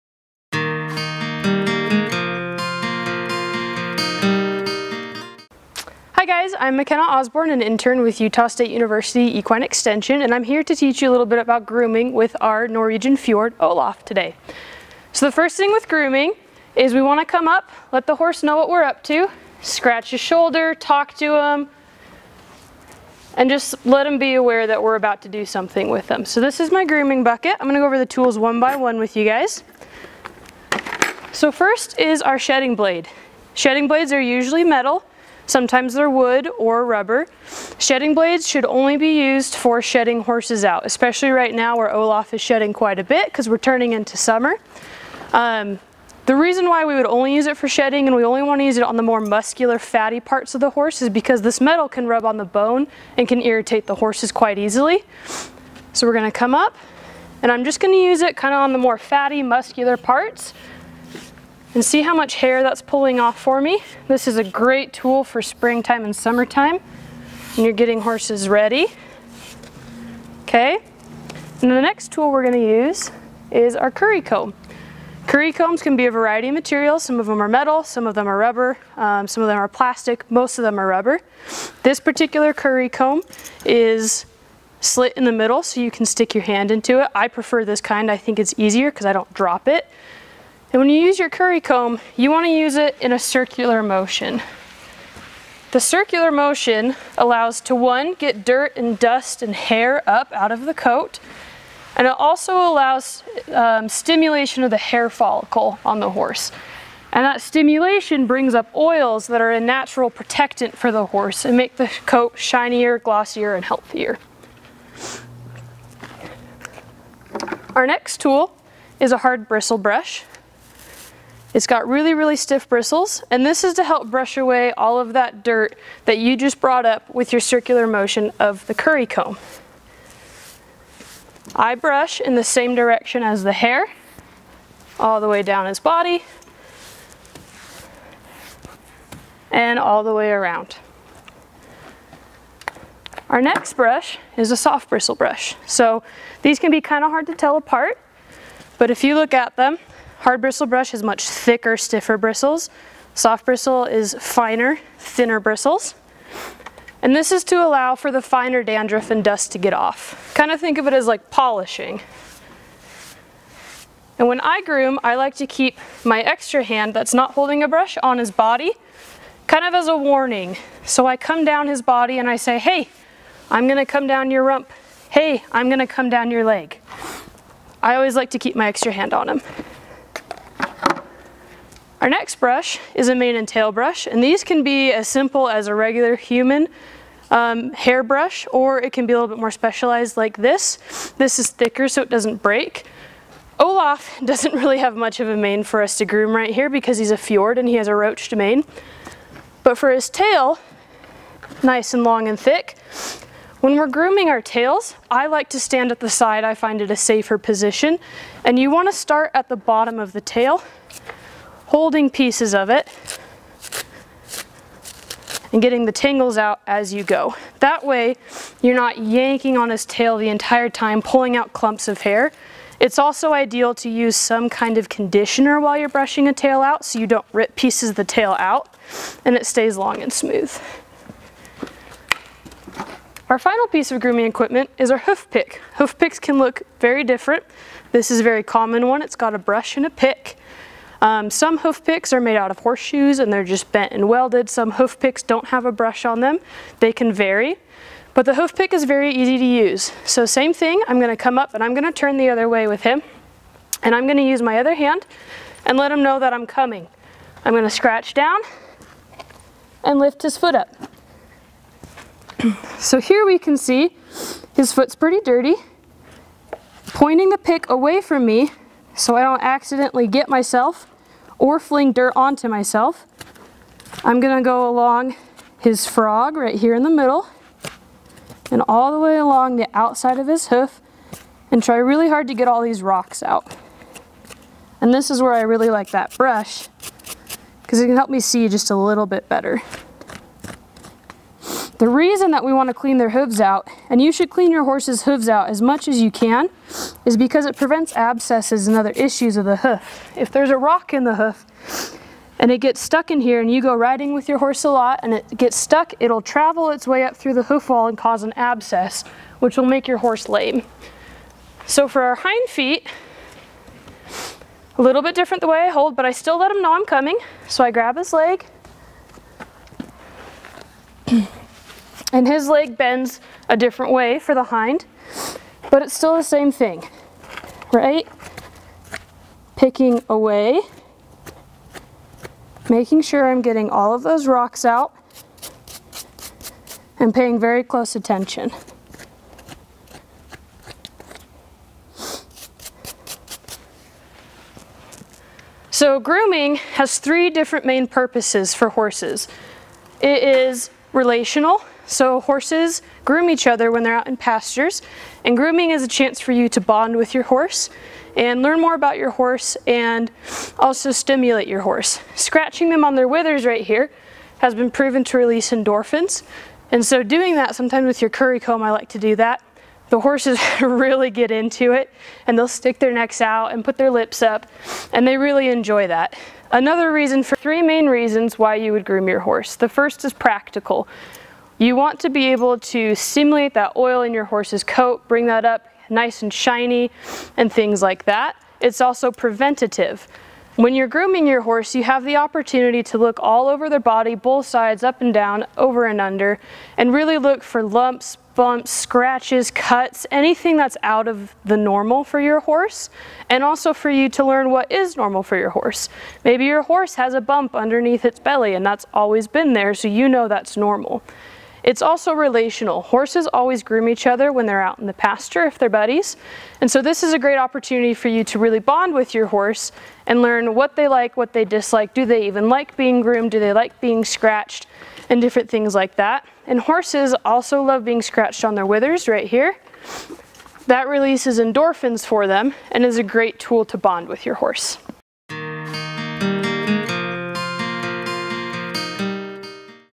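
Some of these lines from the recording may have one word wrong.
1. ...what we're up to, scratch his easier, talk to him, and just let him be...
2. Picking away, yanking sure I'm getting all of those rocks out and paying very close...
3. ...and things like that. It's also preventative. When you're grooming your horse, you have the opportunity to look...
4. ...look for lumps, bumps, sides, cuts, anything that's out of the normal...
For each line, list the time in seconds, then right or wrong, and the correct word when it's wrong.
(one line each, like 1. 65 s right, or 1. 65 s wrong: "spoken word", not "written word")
1. 18 s wrong: "shoulder", not "easier"
2. 329 s wrong: "making", not "yanking"
3. 387 s right
4. 397 s wrong: "scratches", not "sides".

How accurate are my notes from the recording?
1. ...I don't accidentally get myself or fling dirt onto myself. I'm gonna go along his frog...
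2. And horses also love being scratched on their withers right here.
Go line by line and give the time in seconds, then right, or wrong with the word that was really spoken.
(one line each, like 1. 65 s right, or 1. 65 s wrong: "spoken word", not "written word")
1. 269 s right
2. 426 s right.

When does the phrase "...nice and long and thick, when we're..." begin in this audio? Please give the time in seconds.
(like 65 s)
201 s.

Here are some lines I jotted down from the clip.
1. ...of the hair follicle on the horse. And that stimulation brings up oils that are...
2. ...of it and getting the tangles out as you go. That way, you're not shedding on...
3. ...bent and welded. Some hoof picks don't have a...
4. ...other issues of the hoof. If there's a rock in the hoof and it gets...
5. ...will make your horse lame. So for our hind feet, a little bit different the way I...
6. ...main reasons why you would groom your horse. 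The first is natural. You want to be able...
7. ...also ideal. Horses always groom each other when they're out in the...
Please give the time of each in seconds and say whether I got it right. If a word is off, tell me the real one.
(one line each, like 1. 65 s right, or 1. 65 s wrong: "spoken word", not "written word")
1. 104 s right
2. 212 s wrong: "yanking", not "shedding"
3. 243 s right
4. 298 s right
5. 309 s right
6. 377 s wrong: "practical", not "natural"
7. 411 s wrong: "relational", not "ideal".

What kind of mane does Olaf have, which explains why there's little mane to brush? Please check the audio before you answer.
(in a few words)
Roached mane.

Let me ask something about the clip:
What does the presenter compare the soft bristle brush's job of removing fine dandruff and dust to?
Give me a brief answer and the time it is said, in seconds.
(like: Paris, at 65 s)
Polishing, at 161 s.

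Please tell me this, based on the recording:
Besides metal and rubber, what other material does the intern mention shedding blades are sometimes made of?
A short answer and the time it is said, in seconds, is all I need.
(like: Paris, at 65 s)
Wood, at 36 s.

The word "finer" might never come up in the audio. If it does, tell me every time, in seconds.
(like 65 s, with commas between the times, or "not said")
154 s, 158 s.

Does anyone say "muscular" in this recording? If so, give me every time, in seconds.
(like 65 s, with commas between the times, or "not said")
49 s, 59 s.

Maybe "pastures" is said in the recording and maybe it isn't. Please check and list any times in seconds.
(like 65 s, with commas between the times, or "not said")
354 s, 414 s.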